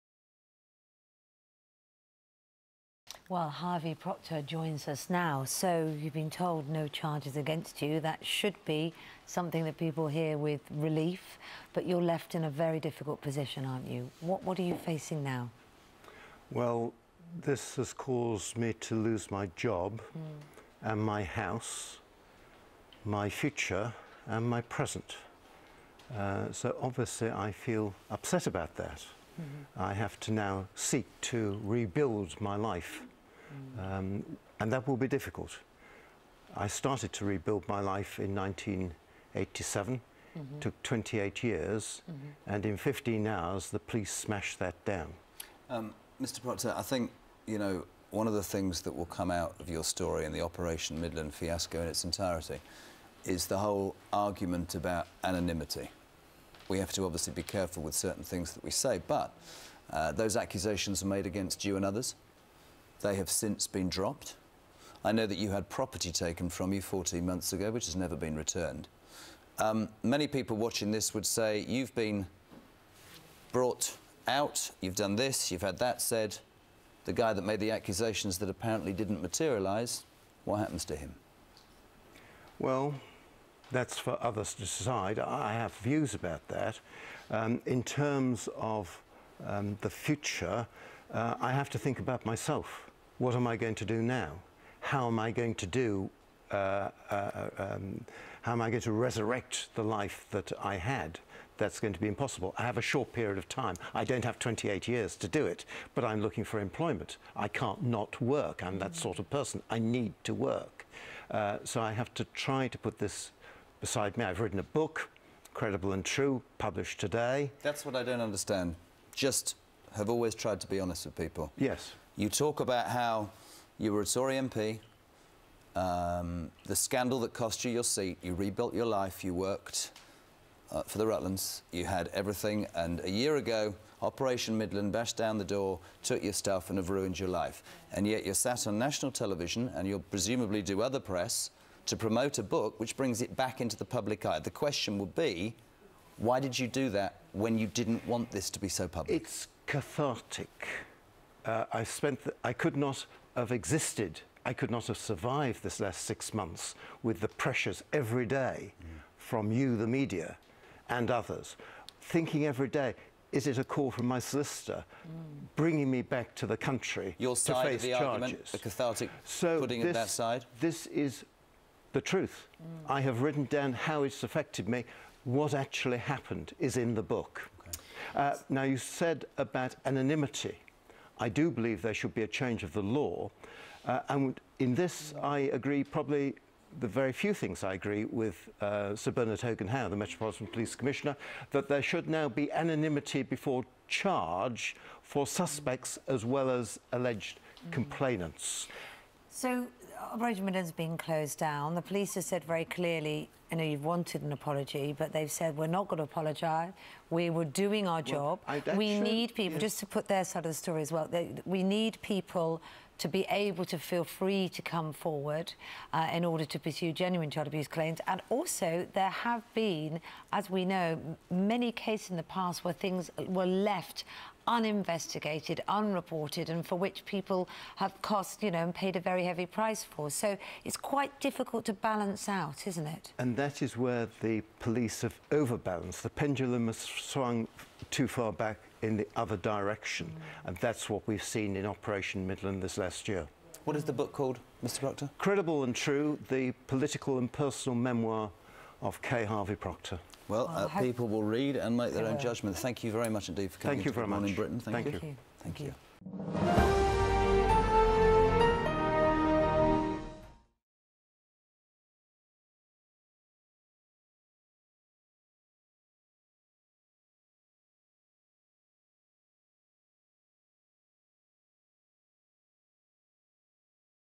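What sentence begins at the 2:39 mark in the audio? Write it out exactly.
from you, the media, and others.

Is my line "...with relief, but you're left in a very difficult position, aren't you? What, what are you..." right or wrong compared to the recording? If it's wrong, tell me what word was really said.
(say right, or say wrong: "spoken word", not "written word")
right.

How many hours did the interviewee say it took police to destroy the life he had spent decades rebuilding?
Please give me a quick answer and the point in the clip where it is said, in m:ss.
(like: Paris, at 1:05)
15, at 0:42.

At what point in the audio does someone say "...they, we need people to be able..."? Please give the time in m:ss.
3:31.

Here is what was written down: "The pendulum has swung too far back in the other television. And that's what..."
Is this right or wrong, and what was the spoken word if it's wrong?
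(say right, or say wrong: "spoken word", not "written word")
wrong: "direction", not "television".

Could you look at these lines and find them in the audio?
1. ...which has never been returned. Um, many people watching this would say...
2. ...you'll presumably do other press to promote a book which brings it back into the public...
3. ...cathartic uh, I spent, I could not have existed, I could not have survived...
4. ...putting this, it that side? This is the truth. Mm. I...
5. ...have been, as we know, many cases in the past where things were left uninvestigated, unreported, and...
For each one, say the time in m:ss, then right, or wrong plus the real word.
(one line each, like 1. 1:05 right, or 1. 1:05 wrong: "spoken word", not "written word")
1. 1:07 right
2. 2:19 right
3. 2:29 right
4. 2:49 right
5. 3:39 right.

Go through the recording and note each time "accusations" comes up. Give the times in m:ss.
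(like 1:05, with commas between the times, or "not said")
1:00, 1:17.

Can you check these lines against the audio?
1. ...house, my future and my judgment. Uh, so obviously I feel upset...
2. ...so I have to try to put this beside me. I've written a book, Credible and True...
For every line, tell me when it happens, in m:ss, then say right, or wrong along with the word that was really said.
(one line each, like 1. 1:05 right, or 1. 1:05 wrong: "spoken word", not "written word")
1. 0:21 wrong: "present", not "judgment"
2. 1:51 right.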